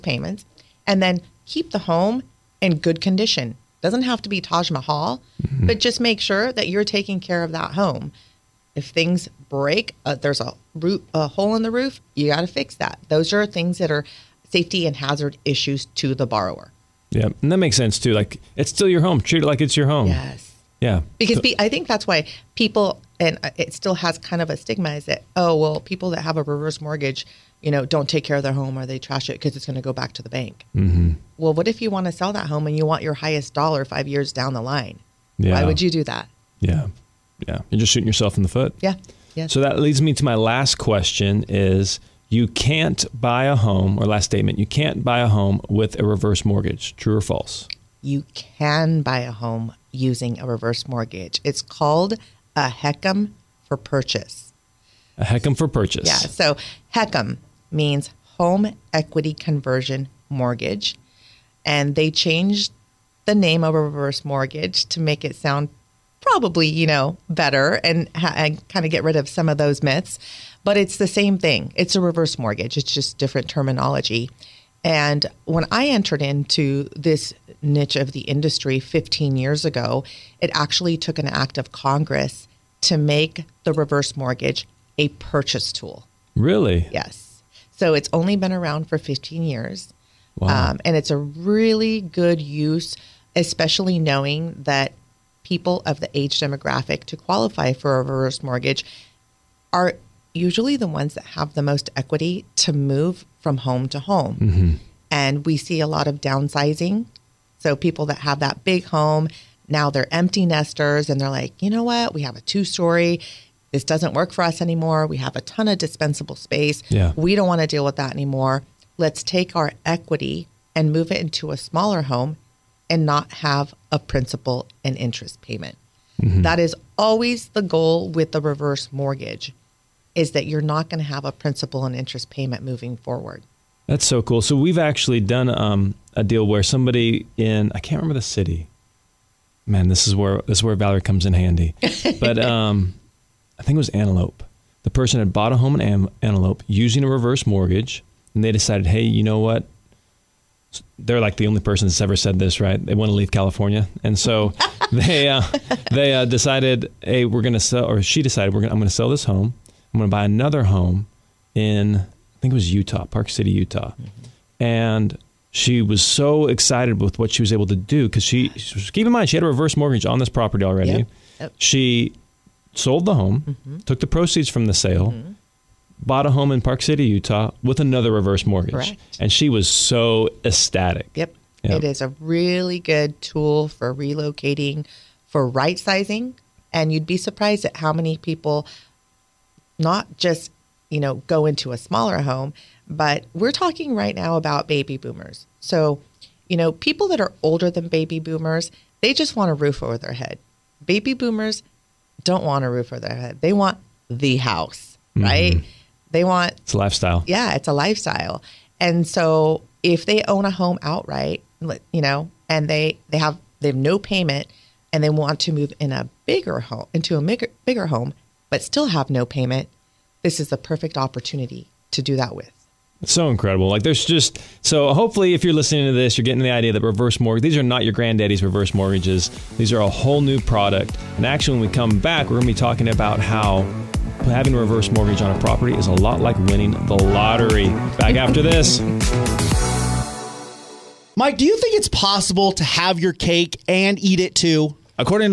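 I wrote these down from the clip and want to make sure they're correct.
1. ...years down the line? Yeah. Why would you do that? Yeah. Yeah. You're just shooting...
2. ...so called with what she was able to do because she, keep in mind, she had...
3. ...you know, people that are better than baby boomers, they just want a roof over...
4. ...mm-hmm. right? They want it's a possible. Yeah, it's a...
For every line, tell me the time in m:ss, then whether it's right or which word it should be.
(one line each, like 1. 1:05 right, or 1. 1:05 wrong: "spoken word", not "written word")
1. 0:34 right
2. 2:46 wrong: "excited", not "called"
3. 3:16 wrong: "older", not "better"
4. 3:25 wrong: "lifestyle", not "possible".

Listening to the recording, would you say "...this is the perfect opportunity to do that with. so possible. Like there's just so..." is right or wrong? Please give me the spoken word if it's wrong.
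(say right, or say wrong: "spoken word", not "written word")
wrong: "incredible", not "possible".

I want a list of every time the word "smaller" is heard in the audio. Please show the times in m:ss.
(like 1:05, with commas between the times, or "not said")
2:01, 3:11.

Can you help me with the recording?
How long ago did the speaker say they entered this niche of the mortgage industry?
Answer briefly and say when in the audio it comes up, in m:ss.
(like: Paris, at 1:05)
15 years ago, at 1:18.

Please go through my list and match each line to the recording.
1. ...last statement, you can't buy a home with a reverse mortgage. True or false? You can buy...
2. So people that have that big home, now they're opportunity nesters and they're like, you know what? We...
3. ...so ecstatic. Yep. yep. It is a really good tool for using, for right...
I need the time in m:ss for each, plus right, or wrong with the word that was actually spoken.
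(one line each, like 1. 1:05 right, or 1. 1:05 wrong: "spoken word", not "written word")
1. 0:44 right
2. 1:47 wrong: "empty", not "opportunity"
3. 2:59 wrong: "relocating", not "using".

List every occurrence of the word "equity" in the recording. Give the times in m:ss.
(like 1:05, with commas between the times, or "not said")
0:58, 1:41, 1:59.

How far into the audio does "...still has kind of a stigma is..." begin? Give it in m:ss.
0:23.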